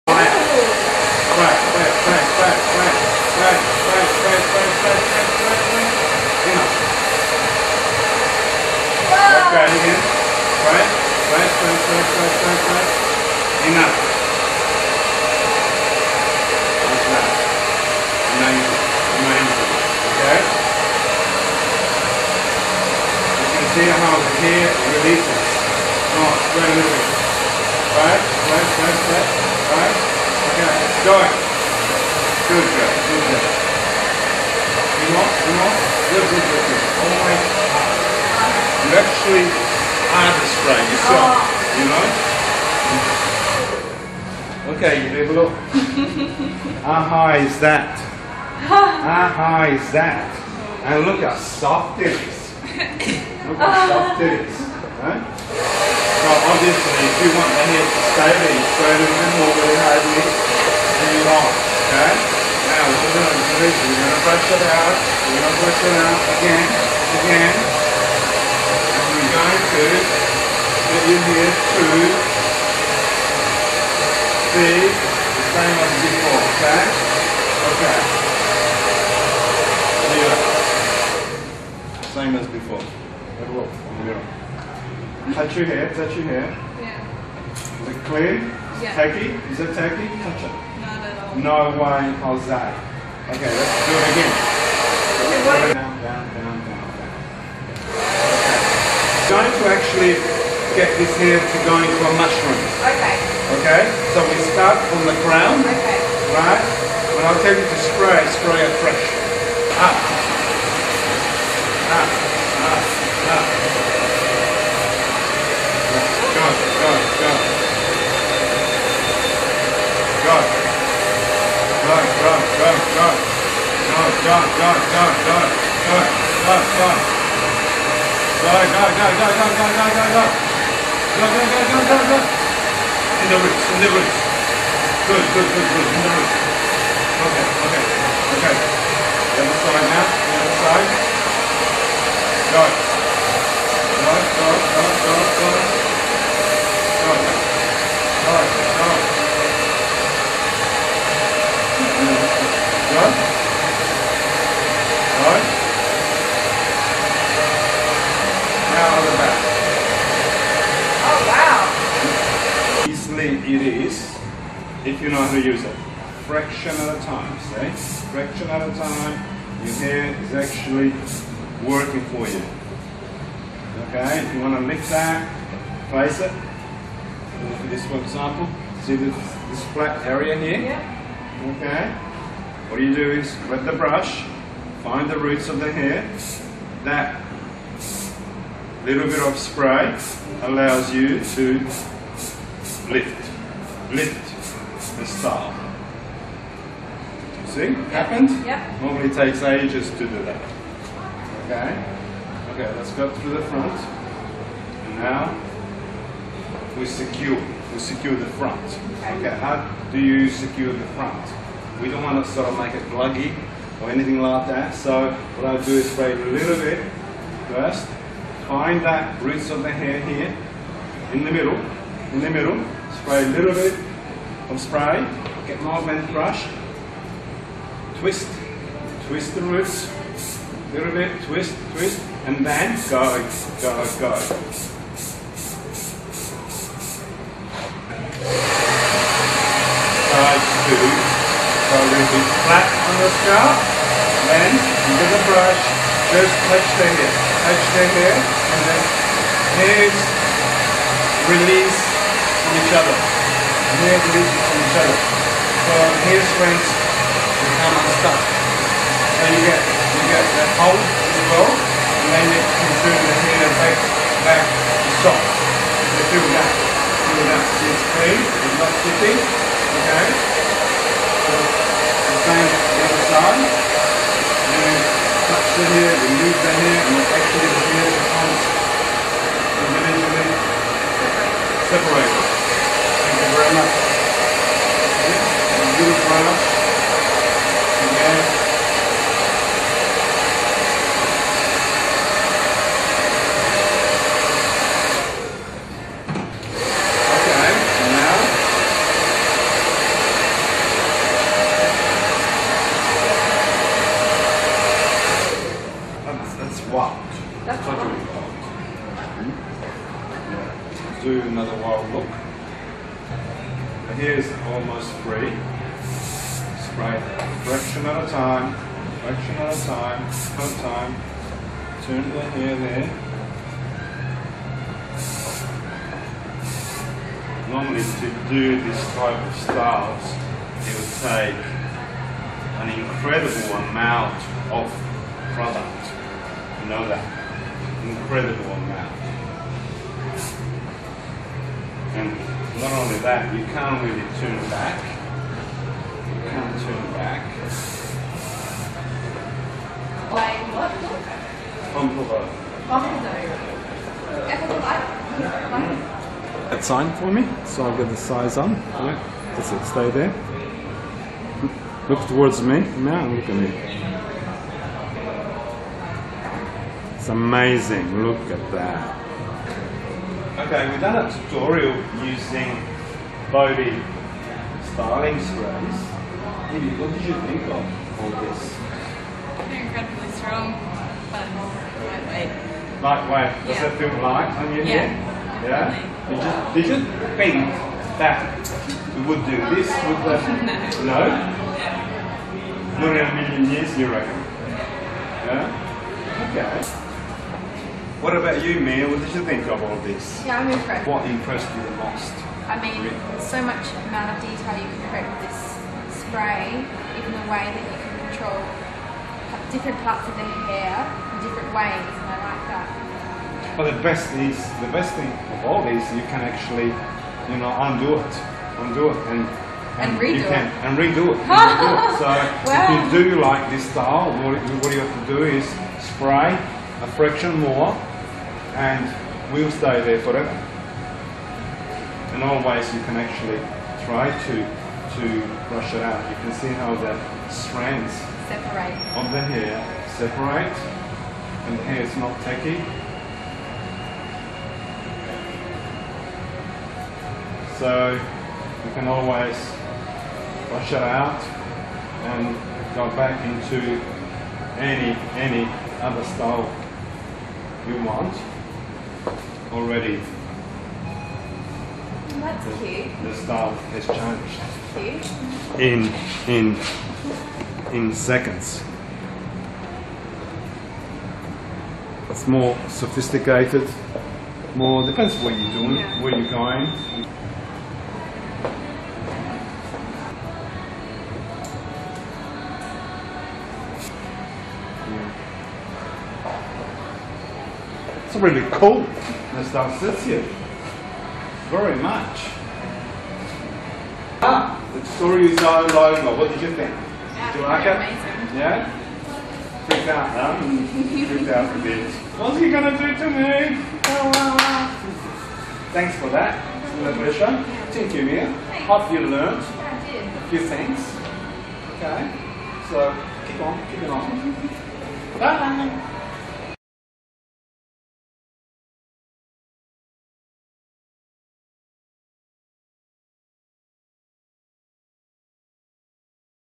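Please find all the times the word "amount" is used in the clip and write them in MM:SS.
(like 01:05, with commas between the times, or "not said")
05:33, 05:38, 06:43.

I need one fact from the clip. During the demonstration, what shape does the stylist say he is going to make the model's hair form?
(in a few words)
Mushroom.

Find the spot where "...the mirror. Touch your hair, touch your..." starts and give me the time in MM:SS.
01:23.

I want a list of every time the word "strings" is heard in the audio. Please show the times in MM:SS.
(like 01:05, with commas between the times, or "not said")
04:16.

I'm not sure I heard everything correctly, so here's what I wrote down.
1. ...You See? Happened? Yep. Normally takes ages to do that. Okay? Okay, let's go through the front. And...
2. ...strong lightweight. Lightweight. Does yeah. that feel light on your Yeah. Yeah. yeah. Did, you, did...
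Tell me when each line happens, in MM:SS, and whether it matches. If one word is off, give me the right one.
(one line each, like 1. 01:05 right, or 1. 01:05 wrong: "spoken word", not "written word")
1. 03:17 right
2. 06:20 right.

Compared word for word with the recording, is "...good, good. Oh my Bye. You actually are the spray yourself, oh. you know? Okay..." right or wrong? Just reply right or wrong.
wrong.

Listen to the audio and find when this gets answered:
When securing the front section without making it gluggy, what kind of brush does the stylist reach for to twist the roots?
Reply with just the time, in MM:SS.
03:45.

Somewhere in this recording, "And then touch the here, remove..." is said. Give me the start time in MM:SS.
04:34.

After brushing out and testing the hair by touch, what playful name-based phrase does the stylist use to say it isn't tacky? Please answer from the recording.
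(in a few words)
No way, Jose.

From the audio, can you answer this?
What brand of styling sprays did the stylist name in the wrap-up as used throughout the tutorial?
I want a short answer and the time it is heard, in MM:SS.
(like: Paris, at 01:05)
Bodii, at 06:13.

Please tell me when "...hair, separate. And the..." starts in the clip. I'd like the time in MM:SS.
07:19.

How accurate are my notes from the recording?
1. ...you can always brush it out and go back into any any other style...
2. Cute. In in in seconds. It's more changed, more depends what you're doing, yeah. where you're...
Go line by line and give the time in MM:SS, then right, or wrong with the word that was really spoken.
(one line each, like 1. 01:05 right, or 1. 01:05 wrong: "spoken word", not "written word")
1. 07:27 right
2. 07:45 wrong: "sophisticated", not "changed".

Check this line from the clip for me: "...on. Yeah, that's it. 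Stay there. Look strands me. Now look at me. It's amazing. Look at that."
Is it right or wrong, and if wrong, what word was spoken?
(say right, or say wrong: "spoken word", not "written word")
wrong: "towards", not "strands".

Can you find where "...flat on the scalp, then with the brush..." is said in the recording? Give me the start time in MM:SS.
04:02.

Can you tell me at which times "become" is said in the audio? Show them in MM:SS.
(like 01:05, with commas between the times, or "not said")
04:17, 04:38.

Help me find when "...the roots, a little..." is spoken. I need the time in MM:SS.
03:49.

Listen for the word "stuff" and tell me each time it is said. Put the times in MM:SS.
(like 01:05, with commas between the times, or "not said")
08:09.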